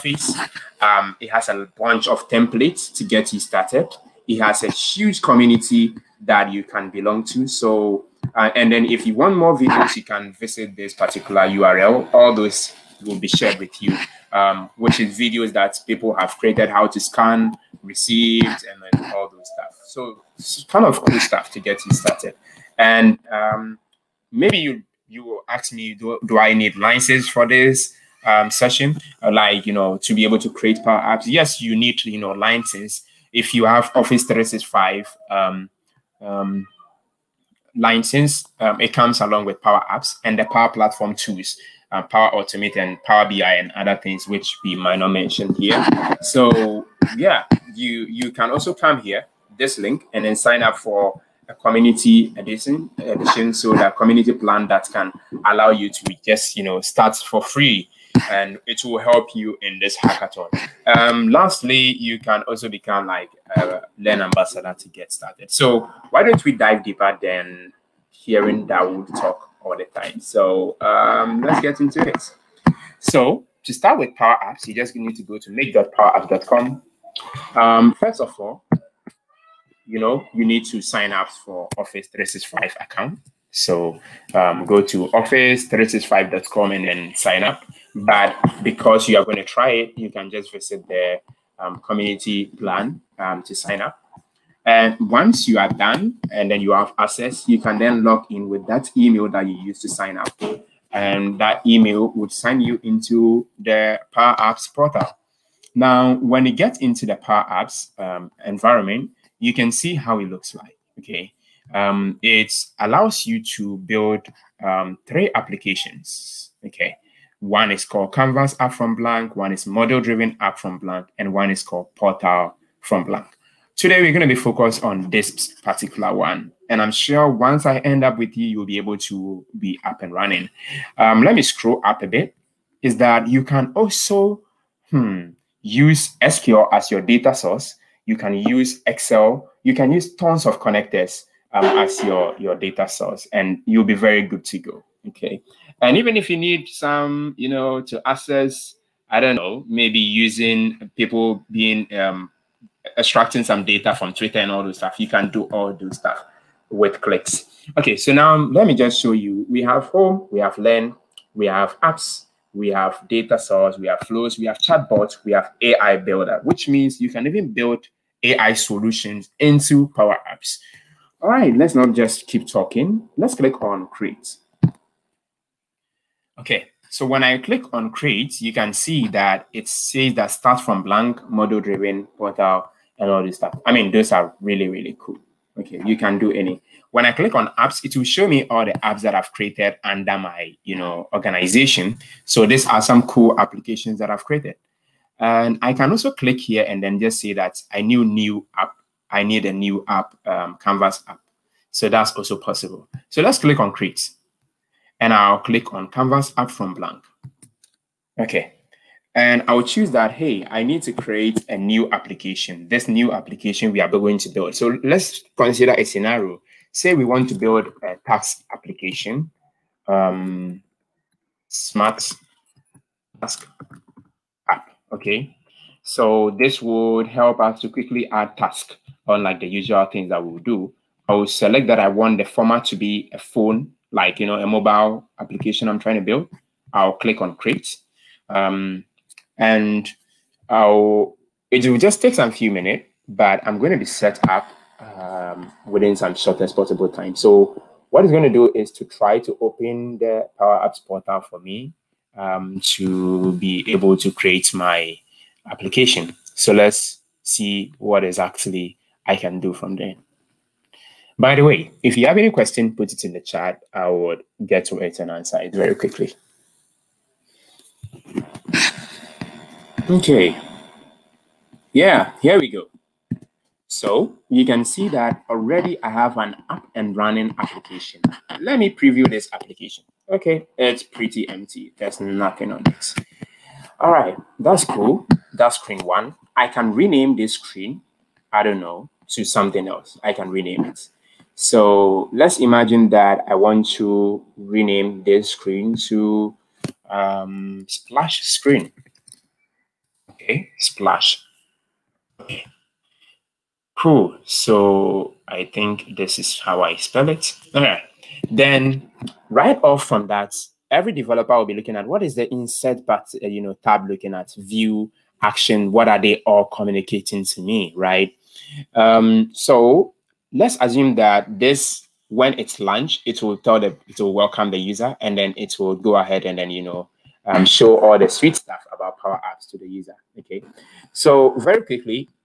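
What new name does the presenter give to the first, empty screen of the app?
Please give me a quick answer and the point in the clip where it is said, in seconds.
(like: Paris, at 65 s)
Splash screen, at 297 s.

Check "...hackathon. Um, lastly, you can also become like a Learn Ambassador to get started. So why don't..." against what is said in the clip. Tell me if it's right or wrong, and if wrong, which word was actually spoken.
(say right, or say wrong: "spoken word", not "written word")
right.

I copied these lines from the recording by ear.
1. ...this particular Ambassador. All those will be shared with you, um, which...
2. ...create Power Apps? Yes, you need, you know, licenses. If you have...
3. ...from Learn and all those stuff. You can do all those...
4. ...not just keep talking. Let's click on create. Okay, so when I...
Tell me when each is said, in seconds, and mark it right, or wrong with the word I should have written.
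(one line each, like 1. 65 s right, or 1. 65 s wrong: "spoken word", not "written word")
1. 10 s wrong: "URL", not "Ambassador"
2. 30 s right
3. 153 s wrong: "Twitter", not "Learn"
4. 171 s right.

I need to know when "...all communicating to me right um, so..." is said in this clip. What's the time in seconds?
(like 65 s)
316 s.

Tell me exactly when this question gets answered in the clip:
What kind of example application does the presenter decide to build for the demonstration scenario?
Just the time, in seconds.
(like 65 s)
221 s.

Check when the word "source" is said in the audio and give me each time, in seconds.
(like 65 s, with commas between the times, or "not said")
137 s, 142 s, 163 s.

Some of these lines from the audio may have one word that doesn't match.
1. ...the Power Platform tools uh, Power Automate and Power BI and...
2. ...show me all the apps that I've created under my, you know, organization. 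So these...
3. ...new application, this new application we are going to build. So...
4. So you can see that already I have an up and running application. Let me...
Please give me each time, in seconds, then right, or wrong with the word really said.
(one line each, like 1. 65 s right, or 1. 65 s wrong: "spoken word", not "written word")
1. 40 s right
2. 188 s right
3. 211 s right
4. 273 s right.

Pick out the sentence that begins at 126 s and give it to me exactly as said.
And I'm sure once I end up with you, you'll be able to be up and running.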